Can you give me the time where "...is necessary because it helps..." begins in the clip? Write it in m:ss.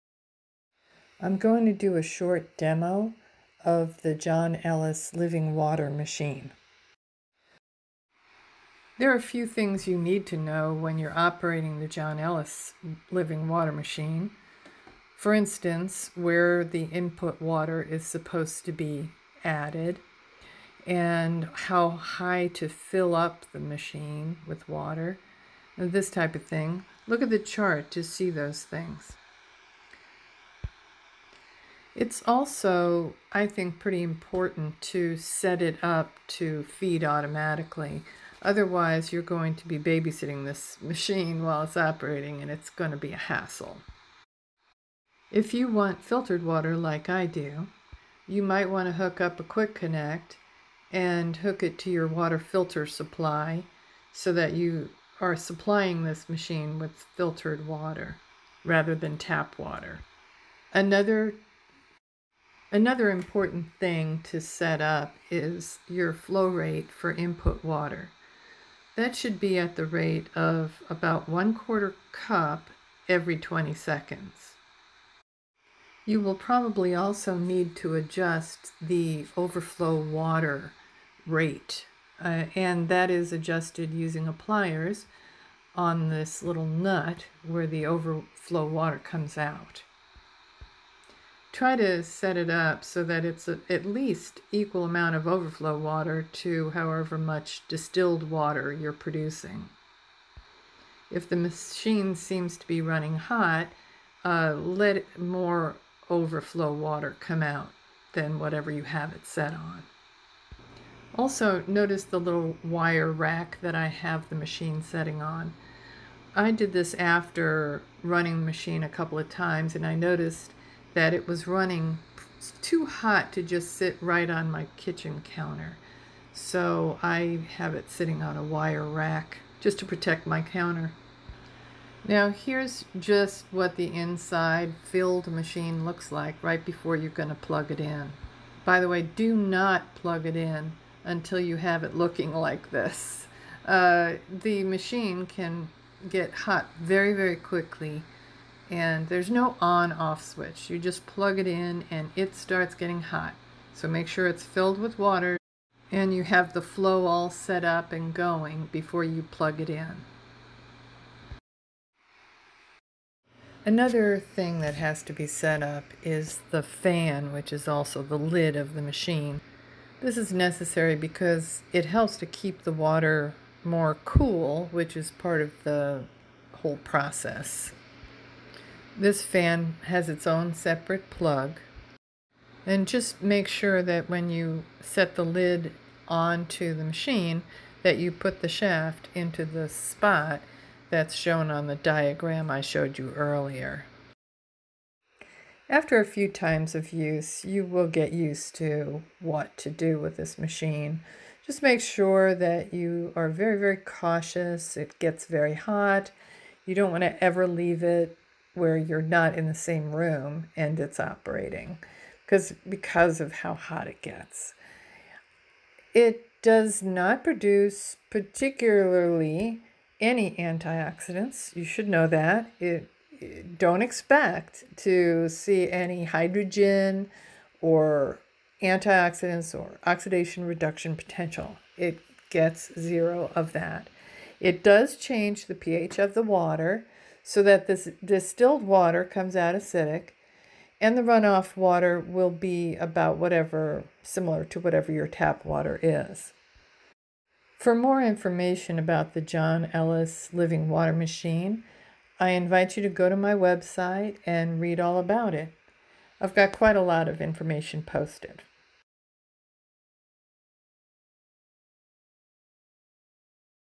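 2:50.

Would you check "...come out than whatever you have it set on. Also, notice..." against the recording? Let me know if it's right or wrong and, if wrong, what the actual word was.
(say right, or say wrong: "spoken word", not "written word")
right.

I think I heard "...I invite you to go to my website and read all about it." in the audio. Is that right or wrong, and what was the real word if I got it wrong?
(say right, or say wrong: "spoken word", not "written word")
right.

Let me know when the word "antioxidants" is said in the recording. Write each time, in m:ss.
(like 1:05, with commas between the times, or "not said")
3:40, 3:48.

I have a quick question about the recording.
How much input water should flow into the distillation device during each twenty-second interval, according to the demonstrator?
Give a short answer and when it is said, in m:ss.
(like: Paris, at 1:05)
1/4 cup, at 1:11.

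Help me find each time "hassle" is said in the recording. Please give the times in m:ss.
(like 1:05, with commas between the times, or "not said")
0:43.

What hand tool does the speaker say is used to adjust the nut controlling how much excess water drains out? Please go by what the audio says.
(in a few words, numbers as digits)
pliers.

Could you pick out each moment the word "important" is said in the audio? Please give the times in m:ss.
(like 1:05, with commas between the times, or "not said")
0:34, 1:03.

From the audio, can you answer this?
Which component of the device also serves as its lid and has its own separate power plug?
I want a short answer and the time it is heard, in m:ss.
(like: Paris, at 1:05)
the fan, at 2:46.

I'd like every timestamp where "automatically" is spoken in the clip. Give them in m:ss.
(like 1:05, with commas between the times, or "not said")
0:37.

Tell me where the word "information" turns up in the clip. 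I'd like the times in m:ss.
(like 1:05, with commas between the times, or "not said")
4:08, 4:17.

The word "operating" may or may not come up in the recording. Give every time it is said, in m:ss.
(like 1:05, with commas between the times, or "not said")
0:11, 0:41, 3:30.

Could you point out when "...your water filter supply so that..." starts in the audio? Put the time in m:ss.
0:51.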